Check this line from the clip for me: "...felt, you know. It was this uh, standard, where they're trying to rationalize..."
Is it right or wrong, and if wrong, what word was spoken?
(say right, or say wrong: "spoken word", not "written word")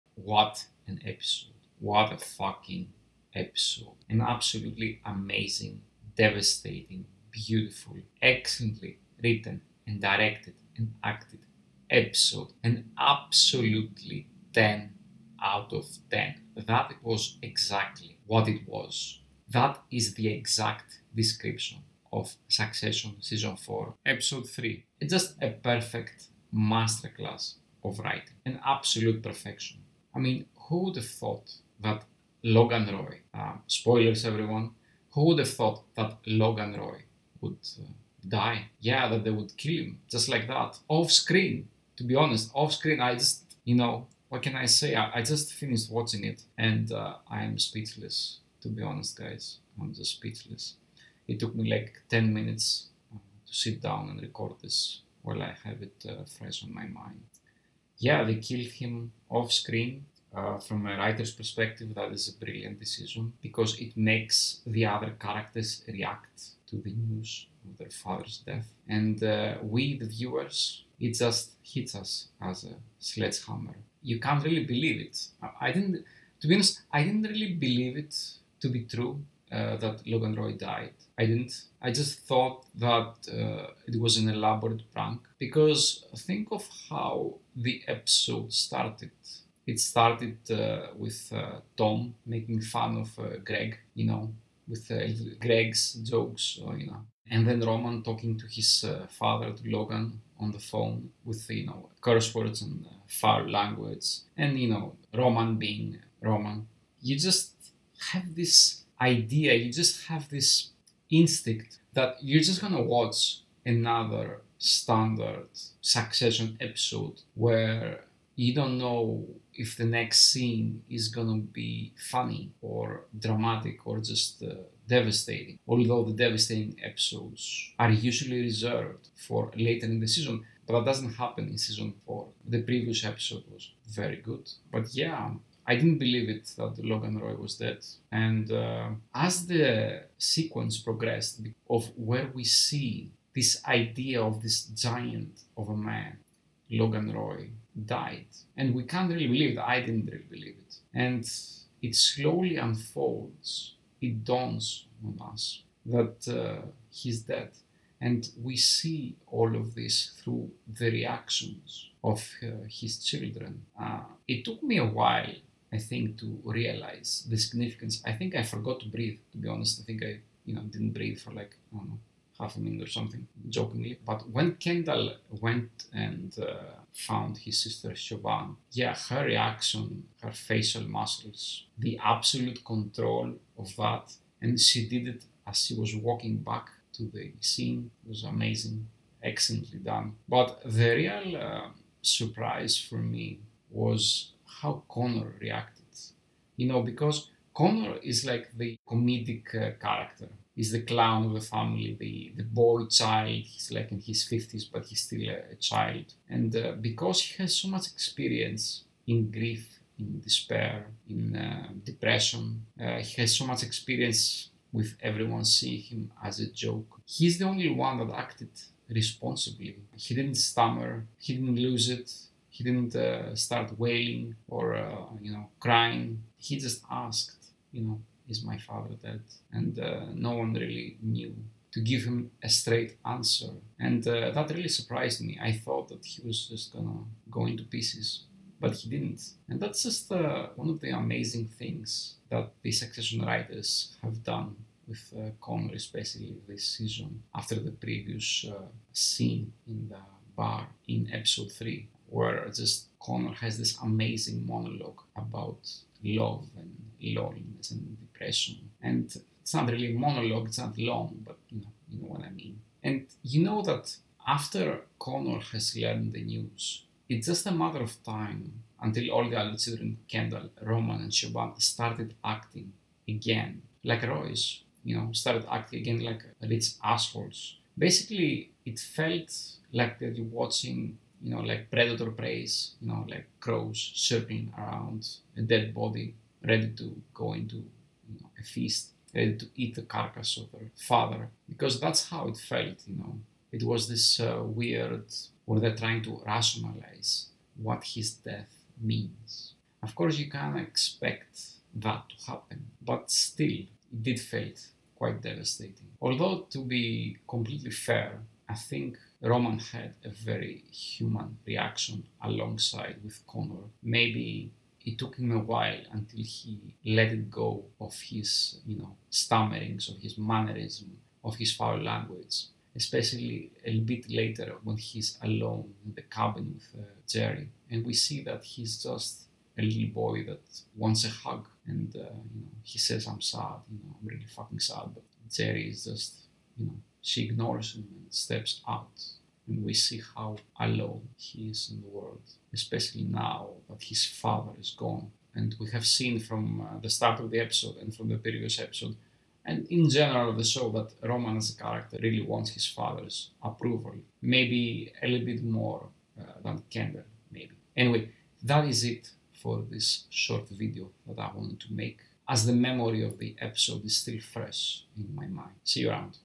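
wrong: "weird", not "standard".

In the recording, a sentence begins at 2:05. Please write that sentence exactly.
Although the devastating episodes are usually reserved for later in the season, but that doesn't happen in season four.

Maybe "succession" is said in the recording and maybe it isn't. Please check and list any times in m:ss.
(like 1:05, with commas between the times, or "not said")
0:22, 1:55, 4:02.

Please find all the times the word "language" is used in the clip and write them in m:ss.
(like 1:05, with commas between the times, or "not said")
1:43, 5:21.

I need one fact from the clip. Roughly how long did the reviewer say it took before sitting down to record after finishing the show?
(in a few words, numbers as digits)
10 minutes.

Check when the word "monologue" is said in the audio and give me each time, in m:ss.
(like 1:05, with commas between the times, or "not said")
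4:14, 4:19.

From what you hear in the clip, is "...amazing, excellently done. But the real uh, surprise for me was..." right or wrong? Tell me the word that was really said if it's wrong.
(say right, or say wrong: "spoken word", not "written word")
right.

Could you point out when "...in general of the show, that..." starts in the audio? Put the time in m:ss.
5:49.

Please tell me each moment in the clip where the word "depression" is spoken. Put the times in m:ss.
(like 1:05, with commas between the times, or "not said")
3:31, 4:17.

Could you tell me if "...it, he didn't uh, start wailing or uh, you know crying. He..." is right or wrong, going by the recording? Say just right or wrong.
right.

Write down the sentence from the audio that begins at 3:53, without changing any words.
And uh, that really surprised me.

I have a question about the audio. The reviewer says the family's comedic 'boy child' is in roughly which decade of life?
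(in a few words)
50s.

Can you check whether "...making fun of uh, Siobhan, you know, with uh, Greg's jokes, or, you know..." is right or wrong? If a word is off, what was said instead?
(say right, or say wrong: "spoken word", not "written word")
wrong: "Greg", not "Siobhan".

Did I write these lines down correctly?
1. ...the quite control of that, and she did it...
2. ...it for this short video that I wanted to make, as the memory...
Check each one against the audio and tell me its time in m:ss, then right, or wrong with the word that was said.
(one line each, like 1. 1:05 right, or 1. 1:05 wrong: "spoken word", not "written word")
1. 3:01 wrong: "absolute", not "quite"
2. 5:58 right.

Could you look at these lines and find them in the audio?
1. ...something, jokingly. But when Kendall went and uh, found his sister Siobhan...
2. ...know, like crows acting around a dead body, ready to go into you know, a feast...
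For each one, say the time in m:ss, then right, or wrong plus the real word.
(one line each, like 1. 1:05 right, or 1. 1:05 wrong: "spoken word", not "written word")
1. 2:52 right
2. 4:42 wrong: "circling", not "acting".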